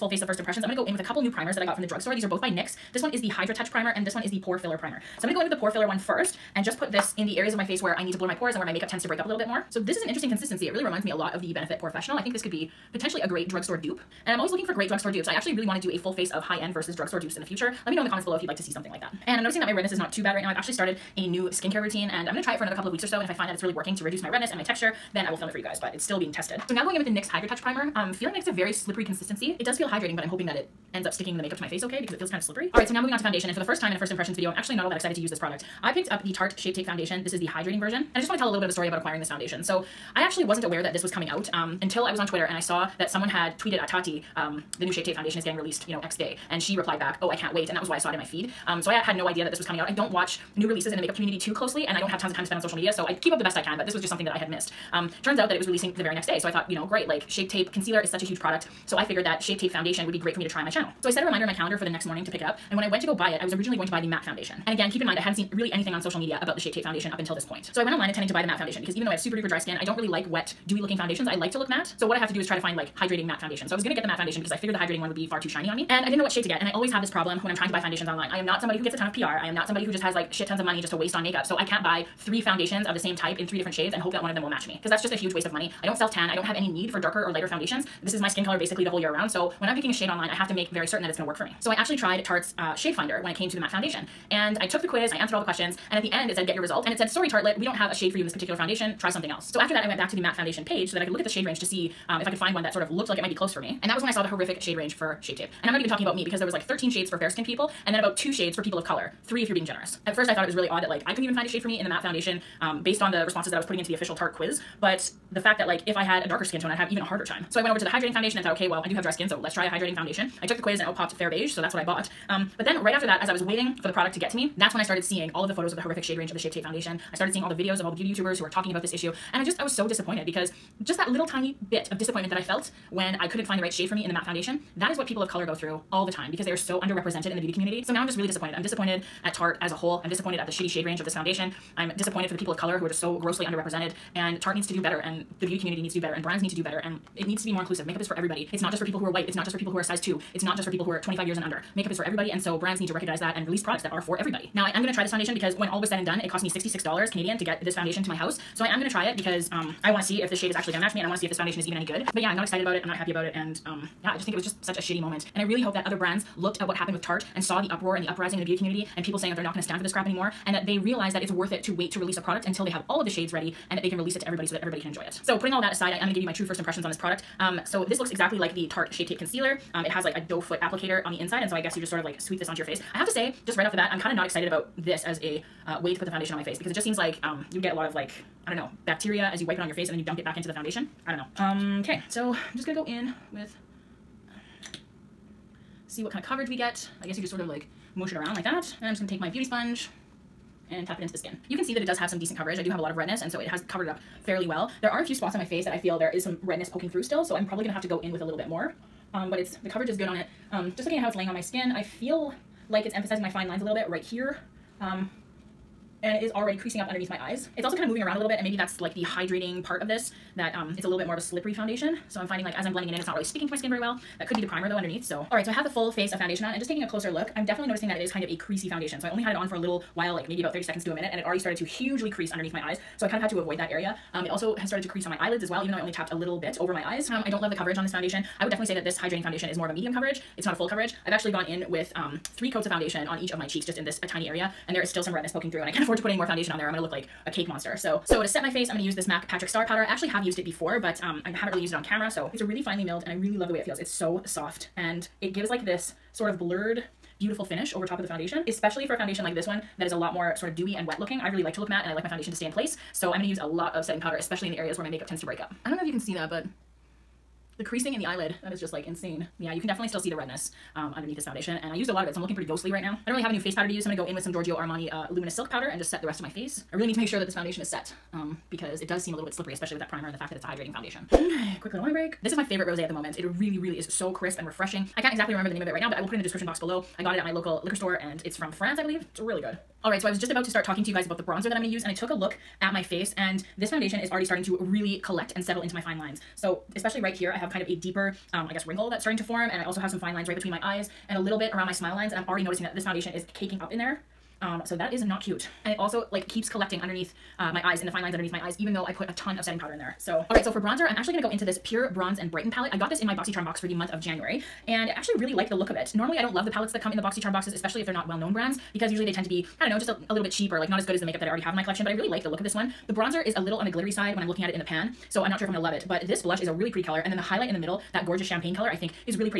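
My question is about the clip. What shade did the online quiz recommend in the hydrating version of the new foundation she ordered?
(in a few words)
Fair Beige.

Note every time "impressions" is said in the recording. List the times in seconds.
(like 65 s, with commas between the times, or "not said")
0 s, 34 s, 176 s.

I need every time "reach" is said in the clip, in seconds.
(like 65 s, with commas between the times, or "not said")
not said.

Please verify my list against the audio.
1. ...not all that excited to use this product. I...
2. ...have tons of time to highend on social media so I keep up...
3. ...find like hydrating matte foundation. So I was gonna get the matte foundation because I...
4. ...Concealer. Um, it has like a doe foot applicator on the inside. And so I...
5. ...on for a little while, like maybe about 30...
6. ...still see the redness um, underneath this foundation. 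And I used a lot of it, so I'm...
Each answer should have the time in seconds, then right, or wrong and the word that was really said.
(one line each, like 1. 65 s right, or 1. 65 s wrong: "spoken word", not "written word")
1. 34 s right
2. 52 s wrong: "spend", not "highend"
3. 72 s right
4. 179 s right
5. 229 s right
6. 269 s right.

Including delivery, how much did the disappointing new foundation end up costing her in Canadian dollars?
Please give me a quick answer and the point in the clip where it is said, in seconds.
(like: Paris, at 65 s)
$66, at 156 s.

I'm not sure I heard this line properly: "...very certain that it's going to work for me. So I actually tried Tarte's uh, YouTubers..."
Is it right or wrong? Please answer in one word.
wrong.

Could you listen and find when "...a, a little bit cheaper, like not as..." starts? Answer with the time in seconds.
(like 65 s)
319 s.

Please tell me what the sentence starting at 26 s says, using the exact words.
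So now going in with the NYX Hydra Touch Primer I'm um, feeling like it's a very slippery consistency.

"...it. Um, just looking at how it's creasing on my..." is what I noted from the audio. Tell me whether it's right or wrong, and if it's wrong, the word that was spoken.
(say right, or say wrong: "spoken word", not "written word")
wrong: "laying", not "creasing".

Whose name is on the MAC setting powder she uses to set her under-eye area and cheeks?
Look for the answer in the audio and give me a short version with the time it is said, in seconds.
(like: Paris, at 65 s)
Patrick Starrr, at 249 s.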